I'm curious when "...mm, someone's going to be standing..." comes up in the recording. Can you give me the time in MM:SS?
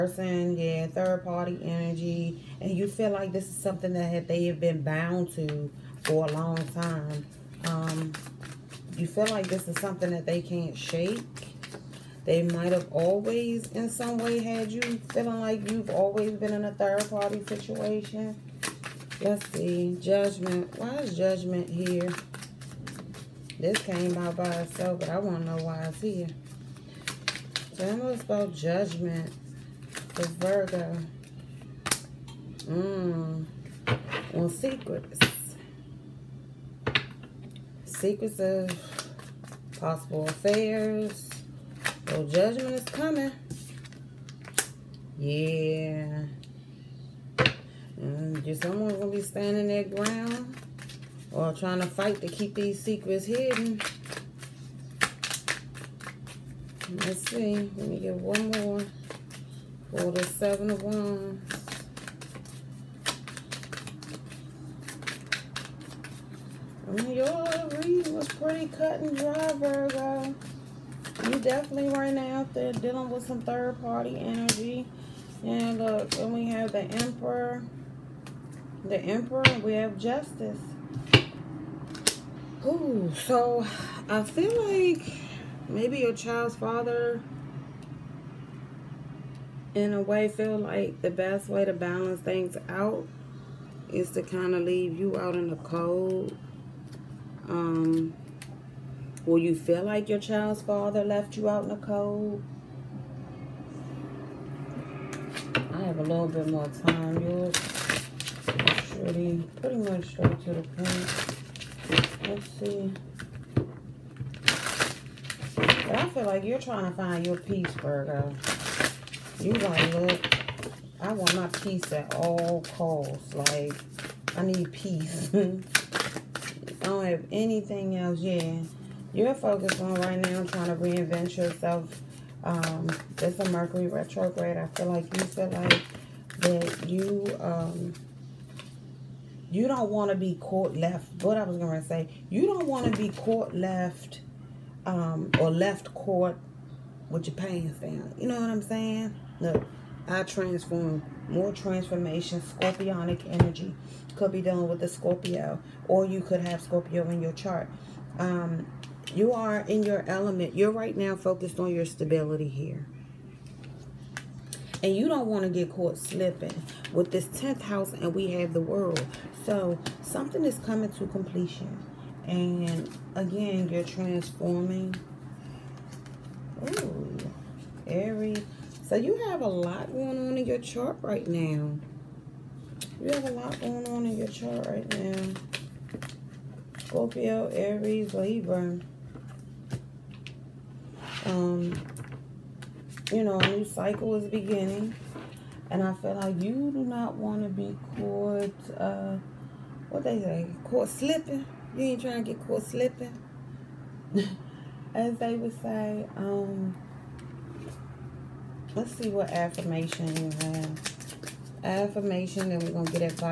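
00:48.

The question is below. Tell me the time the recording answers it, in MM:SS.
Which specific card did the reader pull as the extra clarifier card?
01:00.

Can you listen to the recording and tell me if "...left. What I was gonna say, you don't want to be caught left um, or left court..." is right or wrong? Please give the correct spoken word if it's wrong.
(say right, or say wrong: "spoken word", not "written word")
right.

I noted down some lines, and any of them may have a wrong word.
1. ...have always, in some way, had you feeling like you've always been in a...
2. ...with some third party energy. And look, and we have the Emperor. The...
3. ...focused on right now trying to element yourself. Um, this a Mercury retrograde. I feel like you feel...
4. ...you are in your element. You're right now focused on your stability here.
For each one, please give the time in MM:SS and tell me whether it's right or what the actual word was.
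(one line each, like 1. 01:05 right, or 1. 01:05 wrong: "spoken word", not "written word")
1. 00:12 right
2. 01:13 right
3. 02:09 wrong: "reinvent", not "element"
4. 02:39 right.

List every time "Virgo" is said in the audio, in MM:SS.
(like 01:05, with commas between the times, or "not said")
00:30, 01:09, 01:57.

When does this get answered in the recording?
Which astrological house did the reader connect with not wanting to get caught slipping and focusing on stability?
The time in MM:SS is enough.
02:47.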